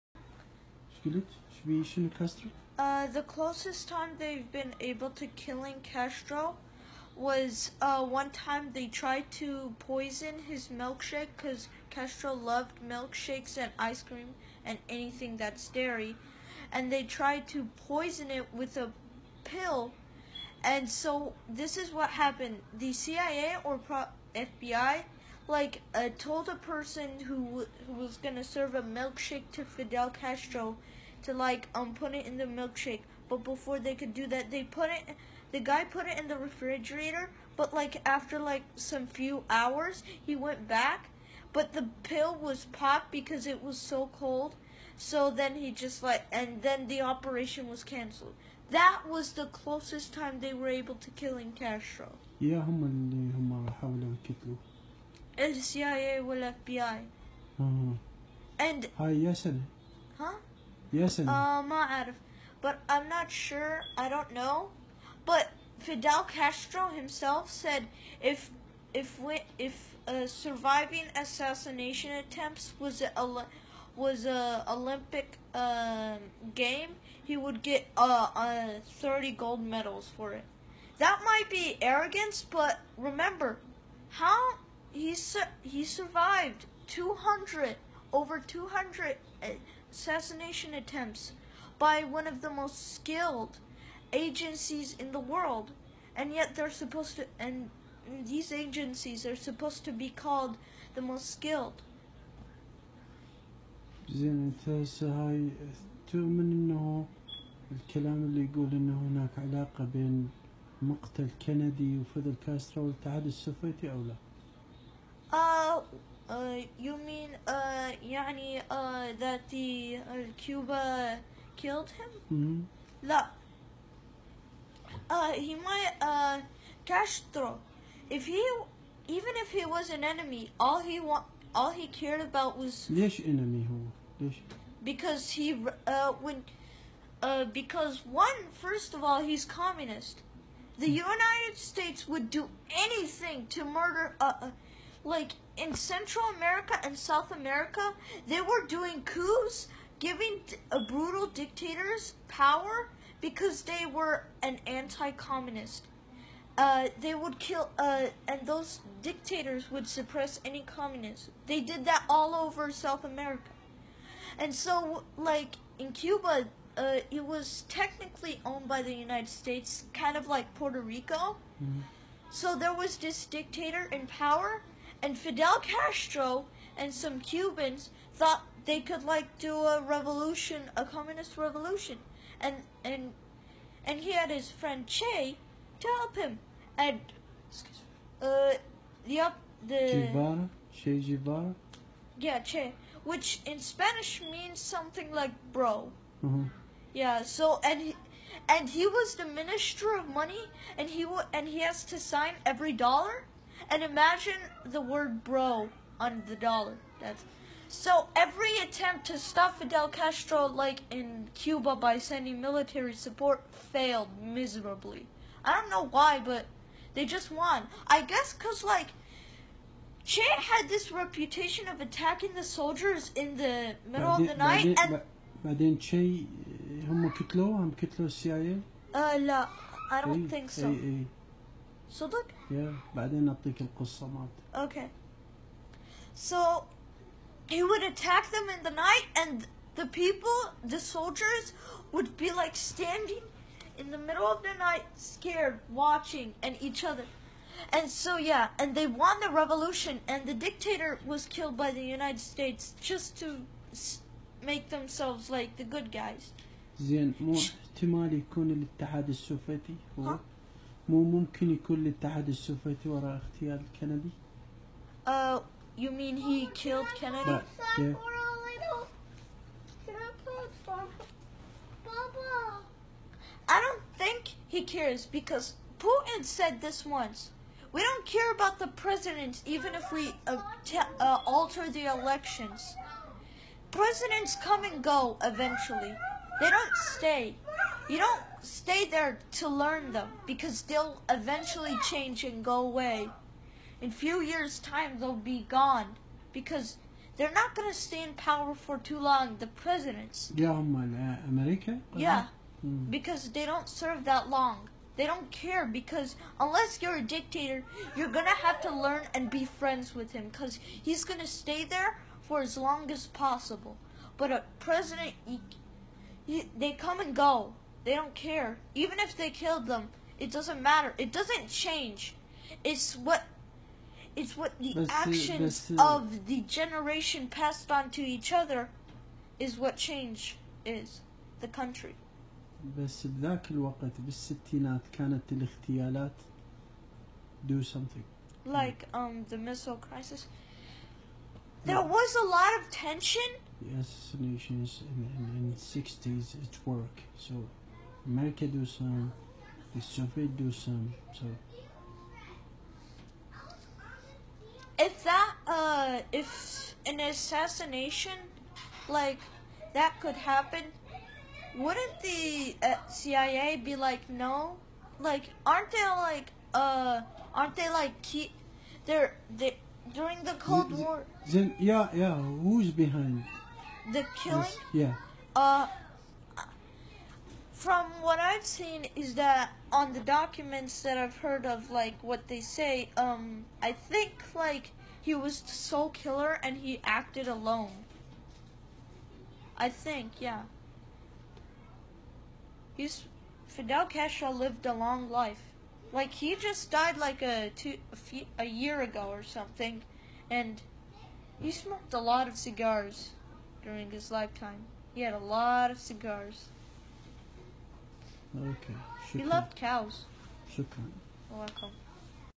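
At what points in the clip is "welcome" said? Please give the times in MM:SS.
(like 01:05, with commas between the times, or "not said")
06:51.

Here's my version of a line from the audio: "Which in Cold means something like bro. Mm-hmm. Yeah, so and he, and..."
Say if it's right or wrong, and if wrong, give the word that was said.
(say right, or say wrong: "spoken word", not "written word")
wrong: "Spanish", not "Cold".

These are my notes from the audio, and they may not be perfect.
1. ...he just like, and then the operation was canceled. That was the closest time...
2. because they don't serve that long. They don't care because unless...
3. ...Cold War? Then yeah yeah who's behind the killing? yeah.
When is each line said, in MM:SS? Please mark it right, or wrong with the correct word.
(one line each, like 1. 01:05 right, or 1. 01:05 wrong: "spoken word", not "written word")
1. 00:45 right
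2. 05:02 right
3. 06:10 right.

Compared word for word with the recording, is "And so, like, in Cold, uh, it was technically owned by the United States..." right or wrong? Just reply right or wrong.
wrong.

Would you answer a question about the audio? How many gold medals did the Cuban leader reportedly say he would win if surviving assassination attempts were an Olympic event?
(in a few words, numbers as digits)
30.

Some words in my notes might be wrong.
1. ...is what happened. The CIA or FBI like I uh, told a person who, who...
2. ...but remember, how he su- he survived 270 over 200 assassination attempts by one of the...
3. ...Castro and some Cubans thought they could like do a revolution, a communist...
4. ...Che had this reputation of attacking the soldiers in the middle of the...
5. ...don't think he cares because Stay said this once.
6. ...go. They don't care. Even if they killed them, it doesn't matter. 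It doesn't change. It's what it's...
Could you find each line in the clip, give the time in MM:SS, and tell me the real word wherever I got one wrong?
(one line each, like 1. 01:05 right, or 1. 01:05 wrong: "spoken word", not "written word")
1. 00:21 right
2. 01:22 wrong: "200", not "270"
3. 02:55 right
4. 03:40 right
5. 04:33 wrong: "Putin", not "Stay"
6. 05:17 right.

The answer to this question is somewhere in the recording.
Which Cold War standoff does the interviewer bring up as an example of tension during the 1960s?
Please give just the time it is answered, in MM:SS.
05:39.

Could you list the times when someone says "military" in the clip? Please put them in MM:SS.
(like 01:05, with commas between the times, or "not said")
03:32.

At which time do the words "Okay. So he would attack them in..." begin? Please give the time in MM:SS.
03:54.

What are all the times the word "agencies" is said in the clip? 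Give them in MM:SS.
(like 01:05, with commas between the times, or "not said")
01:34, 01:38.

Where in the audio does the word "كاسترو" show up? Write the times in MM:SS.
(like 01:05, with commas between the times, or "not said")
01:52.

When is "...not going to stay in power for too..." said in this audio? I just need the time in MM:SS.
04:57.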